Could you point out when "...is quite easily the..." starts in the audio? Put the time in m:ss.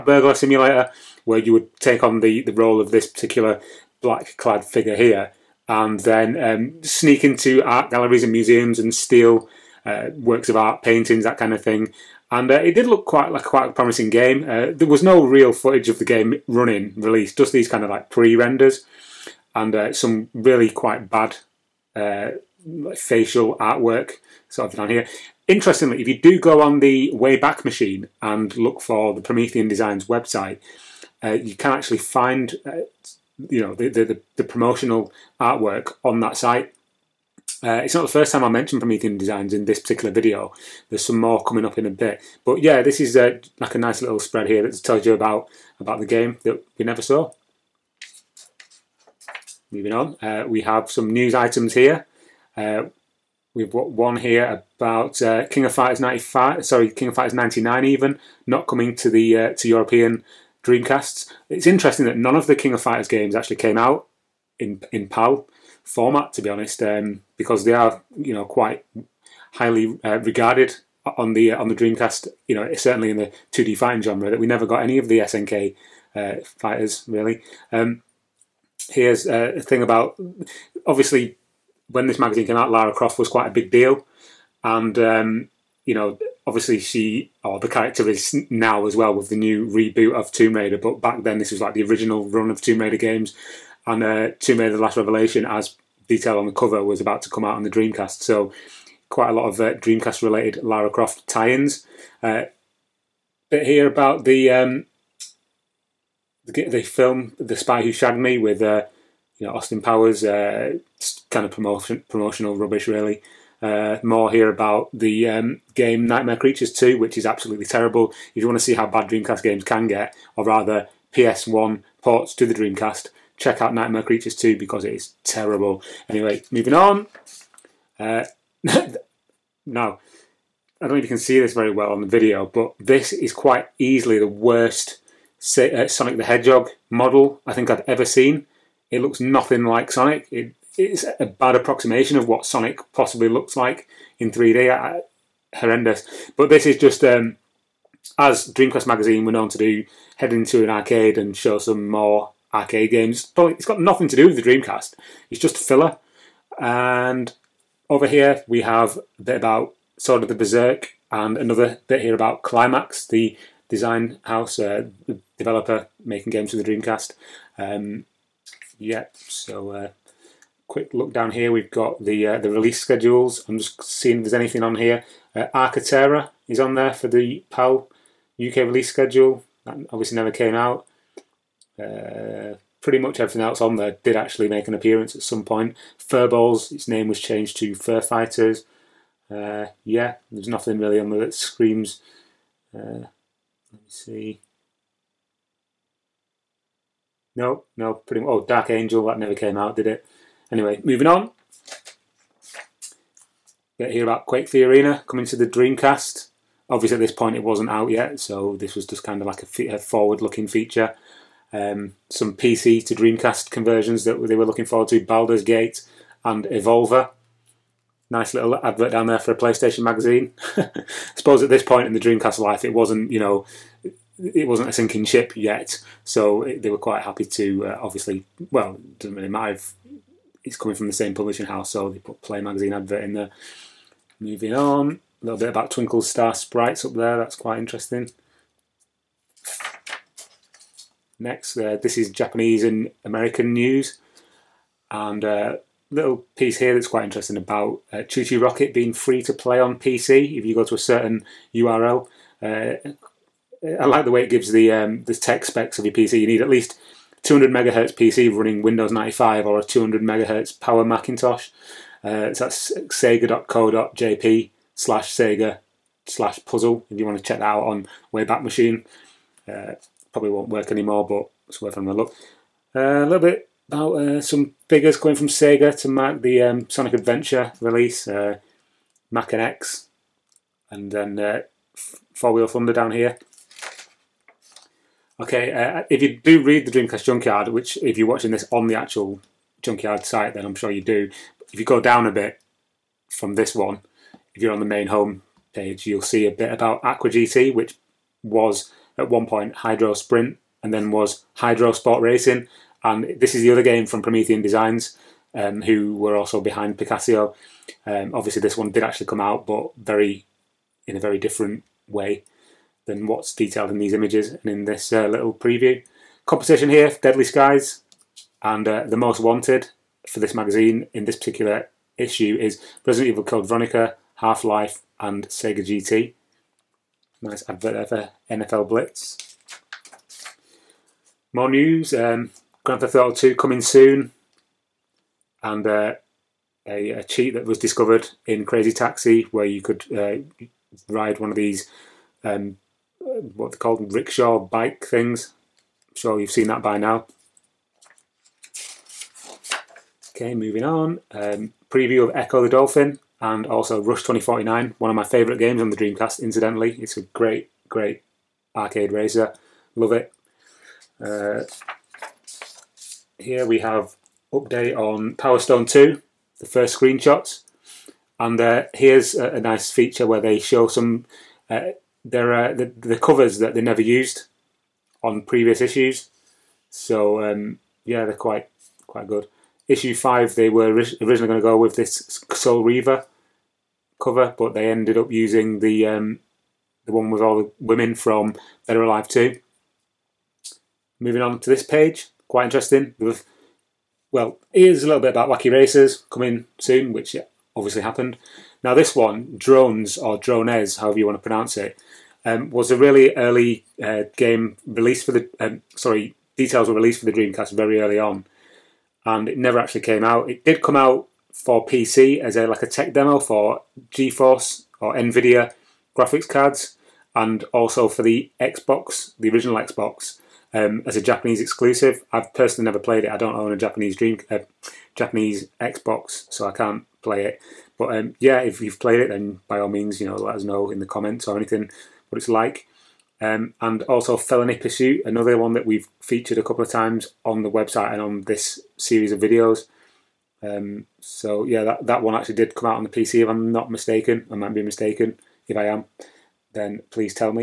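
2:13.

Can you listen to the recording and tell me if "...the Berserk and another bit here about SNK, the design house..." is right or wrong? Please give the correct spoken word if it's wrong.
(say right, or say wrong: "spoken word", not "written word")
wrong: "Climax", not "SNK".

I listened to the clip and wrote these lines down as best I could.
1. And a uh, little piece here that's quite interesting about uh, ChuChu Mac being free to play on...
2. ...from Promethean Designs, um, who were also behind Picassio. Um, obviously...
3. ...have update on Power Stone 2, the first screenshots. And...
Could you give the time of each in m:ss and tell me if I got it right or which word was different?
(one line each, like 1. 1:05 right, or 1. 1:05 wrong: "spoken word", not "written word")
1. 4:04 wrong: "Rocket", not "Mac"
2. 5:03 right
3. 6:03 right.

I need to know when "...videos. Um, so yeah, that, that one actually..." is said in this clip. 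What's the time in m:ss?
7:19.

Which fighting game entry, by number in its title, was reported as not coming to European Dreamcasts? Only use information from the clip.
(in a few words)
King of Fighters 99.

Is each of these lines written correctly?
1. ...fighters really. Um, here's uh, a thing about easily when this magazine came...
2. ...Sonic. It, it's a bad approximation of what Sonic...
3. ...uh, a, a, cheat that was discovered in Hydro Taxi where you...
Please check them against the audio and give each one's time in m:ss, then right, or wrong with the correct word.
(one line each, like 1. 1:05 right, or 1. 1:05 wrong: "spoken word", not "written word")
1. 1:16 wrong: "obviously", not "easily"
2. 2:19 right
3. 5:35 wrong: "Crazy", not "Hydro".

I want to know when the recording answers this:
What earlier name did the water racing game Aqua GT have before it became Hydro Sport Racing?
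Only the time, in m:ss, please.
4:59.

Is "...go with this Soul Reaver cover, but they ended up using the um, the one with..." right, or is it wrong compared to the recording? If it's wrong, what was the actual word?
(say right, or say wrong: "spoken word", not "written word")
right.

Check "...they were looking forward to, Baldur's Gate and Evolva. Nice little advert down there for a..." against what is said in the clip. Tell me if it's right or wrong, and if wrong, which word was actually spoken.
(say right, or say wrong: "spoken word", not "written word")
right.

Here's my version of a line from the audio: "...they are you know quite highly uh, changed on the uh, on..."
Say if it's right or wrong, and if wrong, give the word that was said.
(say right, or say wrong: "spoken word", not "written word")
wrong: "regarded", not "changed".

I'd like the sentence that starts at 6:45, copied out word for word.
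Um, sorry, details were released for the Dreamcast very early on and it never actually came out.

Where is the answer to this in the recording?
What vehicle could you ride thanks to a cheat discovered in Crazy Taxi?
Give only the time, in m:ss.
5:43.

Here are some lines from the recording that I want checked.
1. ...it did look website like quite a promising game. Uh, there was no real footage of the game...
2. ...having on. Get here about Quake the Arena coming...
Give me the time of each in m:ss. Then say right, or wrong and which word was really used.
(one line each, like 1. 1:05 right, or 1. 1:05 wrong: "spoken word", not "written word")
1. 0:12 wrong: "quite", not "website"
2. 3:20 wrong: "moving", not "having".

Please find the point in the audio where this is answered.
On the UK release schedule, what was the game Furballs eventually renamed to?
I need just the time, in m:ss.
3:07.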